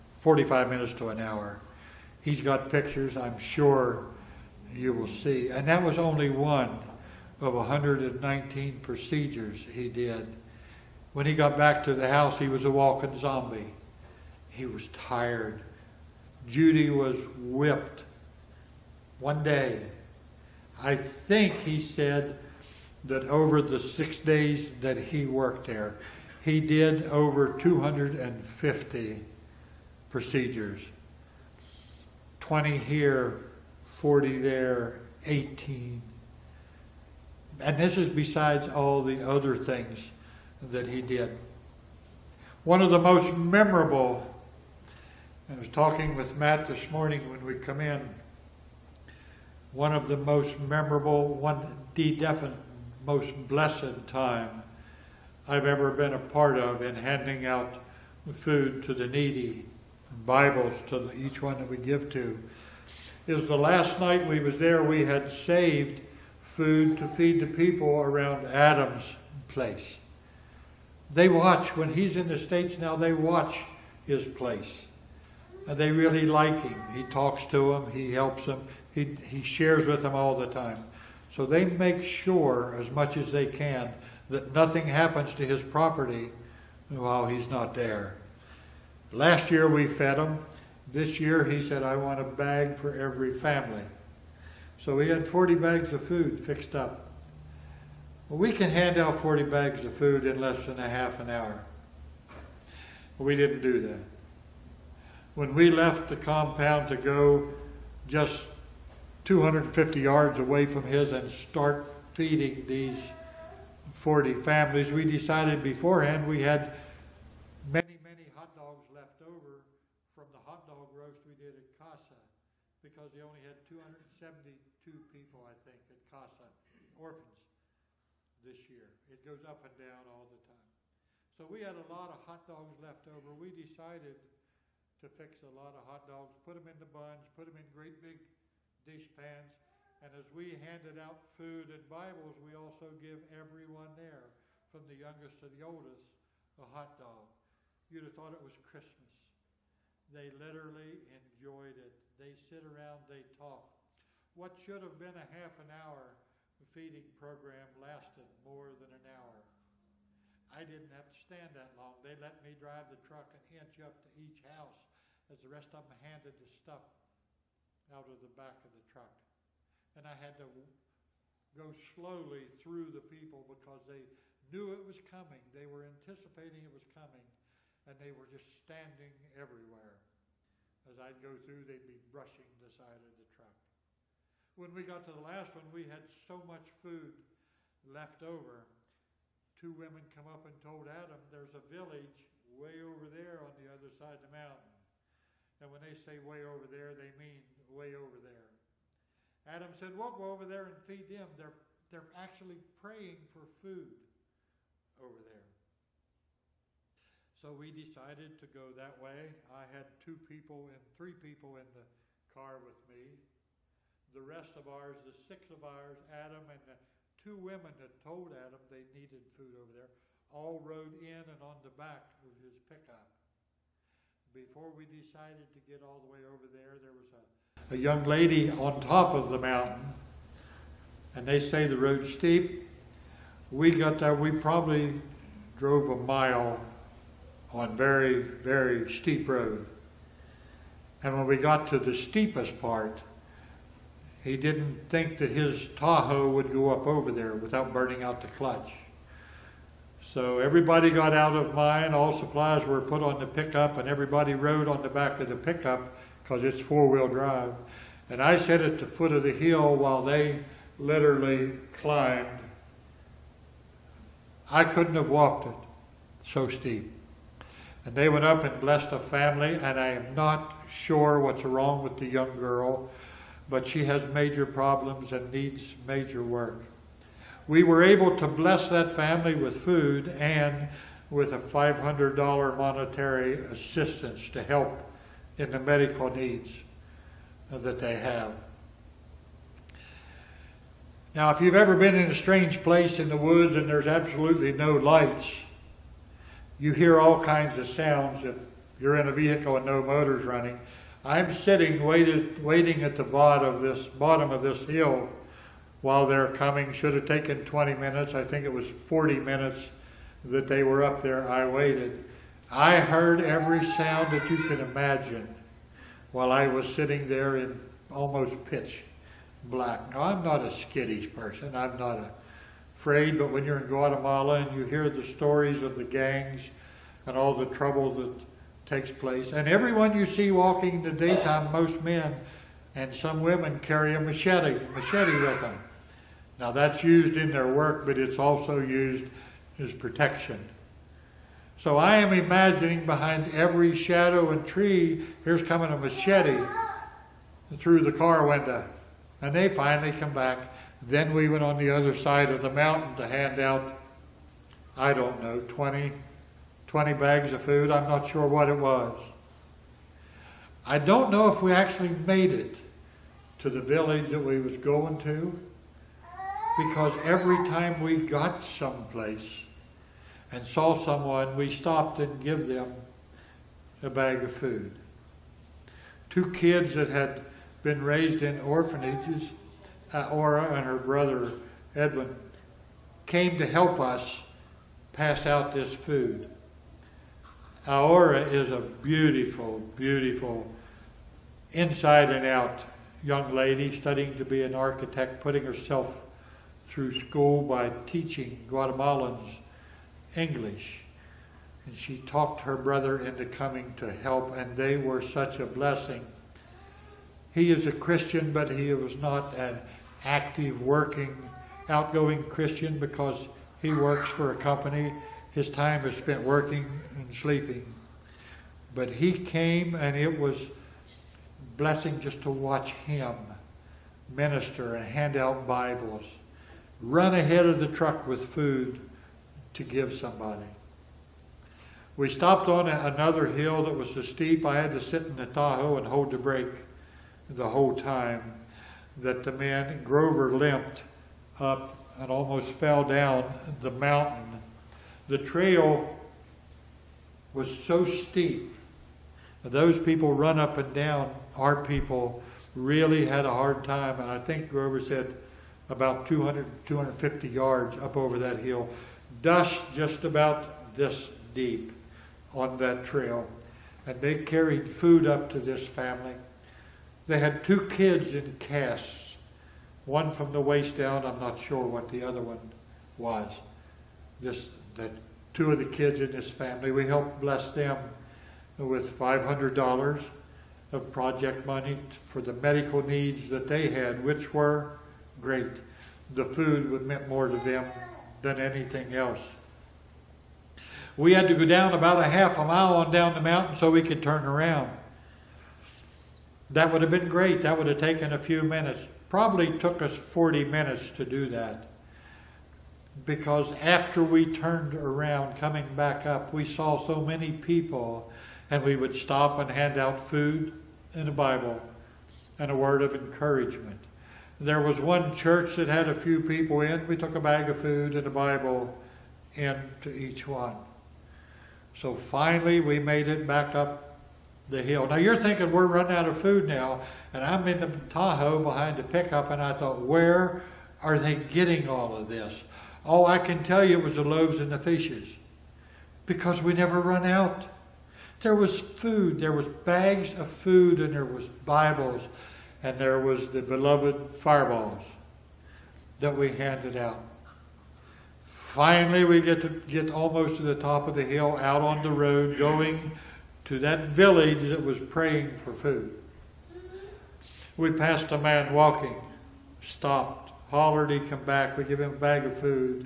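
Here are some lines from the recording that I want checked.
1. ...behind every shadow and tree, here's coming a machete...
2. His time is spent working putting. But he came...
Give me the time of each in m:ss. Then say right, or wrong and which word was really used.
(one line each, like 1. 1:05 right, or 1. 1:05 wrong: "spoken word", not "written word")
1. 5:42 right
2. 6:55 wrong: "sleeping", not "putting".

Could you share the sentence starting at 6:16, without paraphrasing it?
Two kids that had been raised in orphanages, uh, Aura and her brother Edwin, came to help us pass out this food.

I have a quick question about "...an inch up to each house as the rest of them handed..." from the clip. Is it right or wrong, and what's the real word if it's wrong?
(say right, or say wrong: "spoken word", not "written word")
right.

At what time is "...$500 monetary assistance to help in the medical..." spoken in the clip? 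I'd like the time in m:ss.
4:41.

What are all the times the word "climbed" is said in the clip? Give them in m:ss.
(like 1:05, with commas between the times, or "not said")
4:21.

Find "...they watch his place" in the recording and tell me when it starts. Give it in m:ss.
1:12.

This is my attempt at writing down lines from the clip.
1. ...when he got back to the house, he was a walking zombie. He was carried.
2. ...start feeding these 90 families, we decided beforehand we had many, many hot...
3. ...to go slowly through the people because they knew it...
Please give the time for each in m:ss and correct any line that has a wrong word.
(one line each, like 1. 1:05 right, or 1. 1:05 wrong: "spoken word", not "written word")
1. 0:11 wrong: "tired", not "carried"
2. 1:51 wrong: "40", not "90"
3. 2:50 right.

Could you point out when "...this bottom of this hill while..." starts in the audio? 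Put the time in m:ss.
5:03.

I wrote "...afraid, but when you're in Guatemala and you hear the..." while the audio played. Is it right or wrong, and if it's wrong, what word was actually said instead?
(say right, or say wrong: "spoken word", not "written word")
right.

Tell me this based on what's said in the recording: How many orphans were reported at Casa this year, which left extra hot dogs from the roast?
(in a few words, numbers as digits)
272.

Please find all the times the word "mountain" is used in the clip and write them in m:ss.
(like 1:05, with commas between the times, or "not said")
3:14, 3:49, 5:52, 7:23, 8:13.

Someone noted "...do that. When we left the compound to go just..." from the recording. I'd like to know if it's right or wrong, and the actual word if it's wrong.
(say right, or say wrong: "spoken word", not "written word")
right.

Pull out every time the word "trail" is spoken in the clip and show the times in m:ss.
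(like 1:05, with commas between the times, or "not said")
7:25, 7:42.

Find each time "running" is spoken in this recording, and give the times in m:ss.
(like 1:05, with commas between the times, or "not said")
5:00, 8:45.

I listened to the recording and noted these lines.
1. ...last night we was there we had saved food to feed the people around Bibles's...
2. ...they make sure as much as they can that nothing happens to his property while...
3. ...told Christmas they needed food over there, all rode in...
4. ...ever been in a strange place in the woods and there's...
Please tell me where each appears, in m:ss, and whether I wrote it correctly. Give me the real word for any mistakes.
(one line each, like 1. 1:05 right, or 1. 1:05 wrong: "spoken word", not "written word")
1. 1:03 wrong: "Adam", not "Bibles"
2. 1:21 right
3. 3:37 wrong: "Adam", not "Christmas"
4. 4:51 right.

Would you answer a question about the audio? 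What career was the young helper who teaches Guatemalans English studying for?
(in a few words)
architect.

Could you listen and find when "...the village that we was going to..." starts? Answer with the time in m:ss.
6:03.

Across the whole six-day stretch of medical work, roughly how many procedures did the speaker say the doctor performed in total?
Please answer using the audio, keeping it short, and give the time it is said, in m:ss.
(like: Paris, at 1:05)
over 250, at 0:27.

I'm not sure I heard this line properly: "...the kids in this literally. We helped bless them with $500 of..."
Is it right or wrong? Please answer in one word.
wrong.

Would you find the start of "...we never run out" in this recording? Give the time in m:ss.
8:56.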